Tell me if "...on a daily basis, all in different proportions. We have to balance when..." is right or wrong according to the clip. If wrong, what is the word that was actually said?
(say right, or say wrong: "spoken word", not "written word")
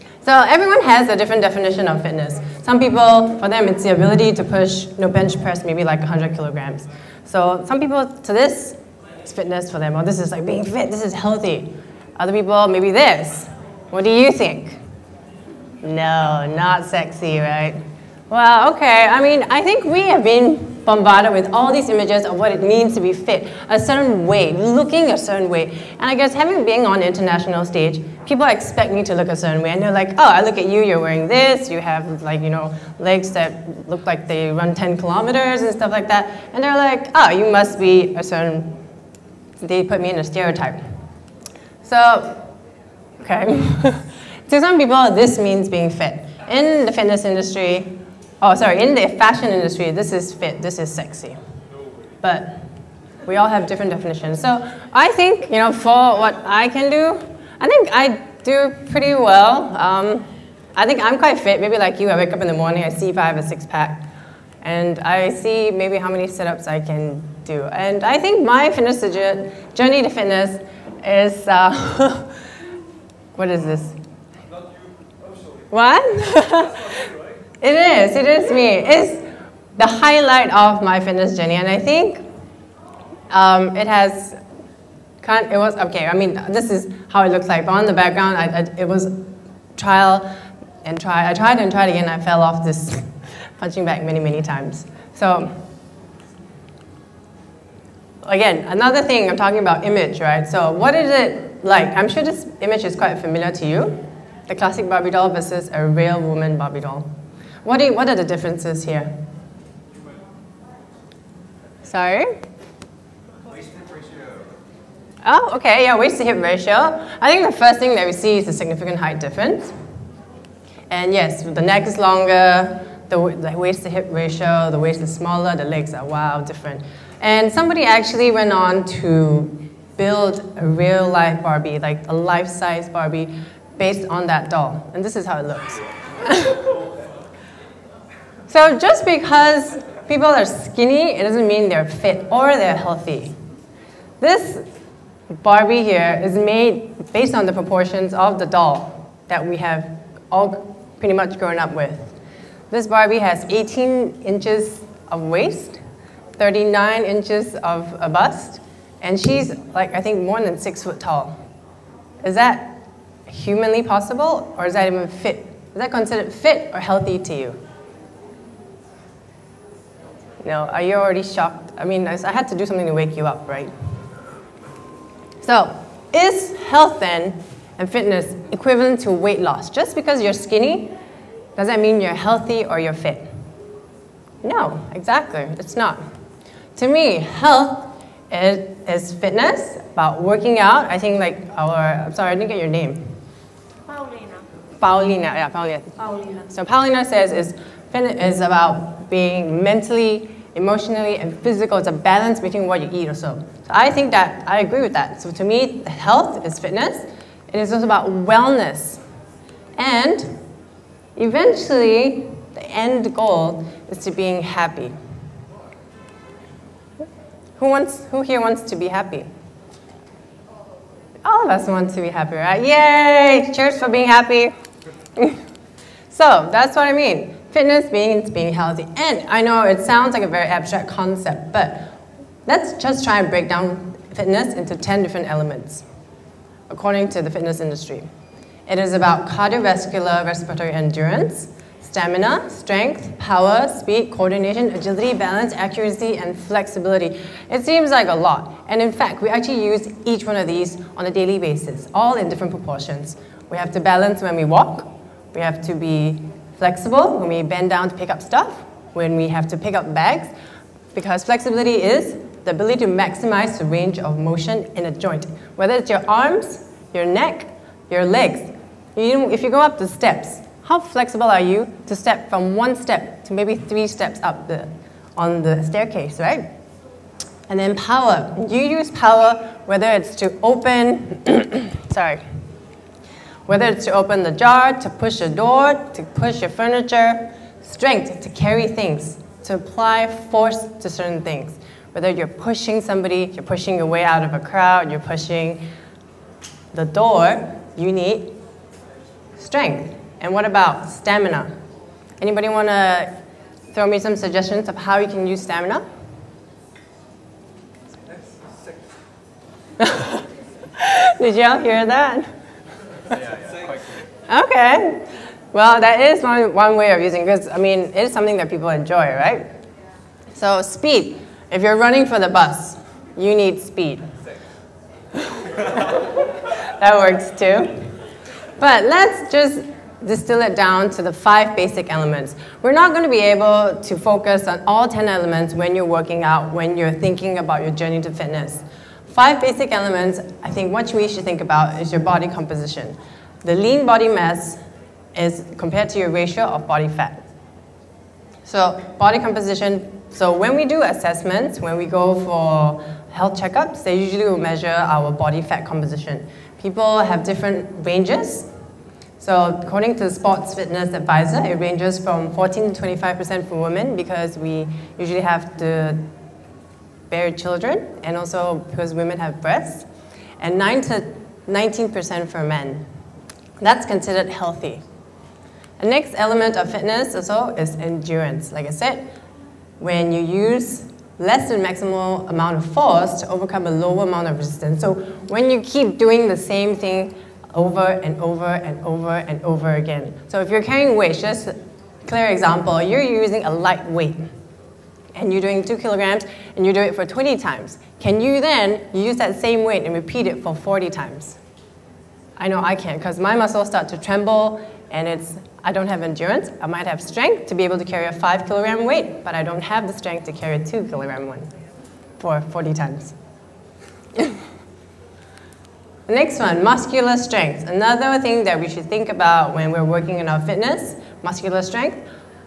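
right.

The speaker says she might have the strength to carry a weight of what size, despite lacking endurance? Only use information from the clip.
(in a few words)
5 kilograms.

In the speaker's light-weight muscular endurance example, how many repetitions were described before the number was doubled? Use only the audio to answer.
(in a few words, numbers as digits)
20.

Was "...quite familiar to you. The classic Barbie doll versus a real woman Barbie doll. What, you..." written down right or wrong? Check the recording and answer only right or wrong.
right.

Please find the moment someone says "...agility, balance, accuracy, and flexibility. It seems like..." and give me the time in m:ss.
4:04.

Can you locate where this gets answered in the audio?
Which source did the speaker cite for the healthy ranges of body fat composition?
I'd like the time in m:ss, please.
6:00.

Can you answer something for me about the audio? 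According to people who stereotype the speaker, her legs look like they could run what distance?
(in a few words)
10 kilometers.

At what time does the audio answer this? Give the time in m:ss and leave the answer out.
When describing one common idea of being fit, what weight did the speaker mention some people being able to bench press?
0:05.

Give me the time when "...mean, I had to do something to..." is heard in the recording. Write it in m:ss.
2:51.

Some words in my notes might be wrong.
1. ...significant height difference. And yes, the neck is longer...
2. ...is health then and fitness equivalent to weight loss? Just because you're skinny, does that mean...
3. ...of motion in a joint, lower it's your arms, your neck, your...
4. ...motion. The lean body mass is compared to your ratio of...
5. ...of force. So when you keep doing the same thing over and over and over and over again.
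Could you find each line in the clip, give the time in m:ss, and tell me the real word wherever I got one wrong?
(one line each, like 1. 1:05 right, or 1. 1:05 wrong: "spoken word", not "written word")
1. 1:58 right
2. 2:56 right
3. 4:23 wrong: "whether", not "lower"
4. 5:42 wrong: "composition", not "motion"
5. 6:24 wrong: "resistance", not "force".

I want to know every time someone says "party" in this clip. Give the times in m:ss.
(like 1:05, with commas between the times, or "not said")
not said.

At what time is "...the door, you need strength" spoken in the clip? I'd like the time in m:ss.
4:56.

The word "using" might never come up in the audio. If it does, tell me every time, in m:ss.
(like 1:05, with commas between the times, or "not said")
5:16, 6:33.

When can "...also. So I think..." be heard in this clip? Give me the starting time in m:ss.
3:23.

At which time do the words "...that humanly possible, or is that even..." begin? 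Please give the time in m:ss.
2:42.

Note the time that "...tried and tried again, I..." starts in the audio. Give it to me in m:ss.
1:31.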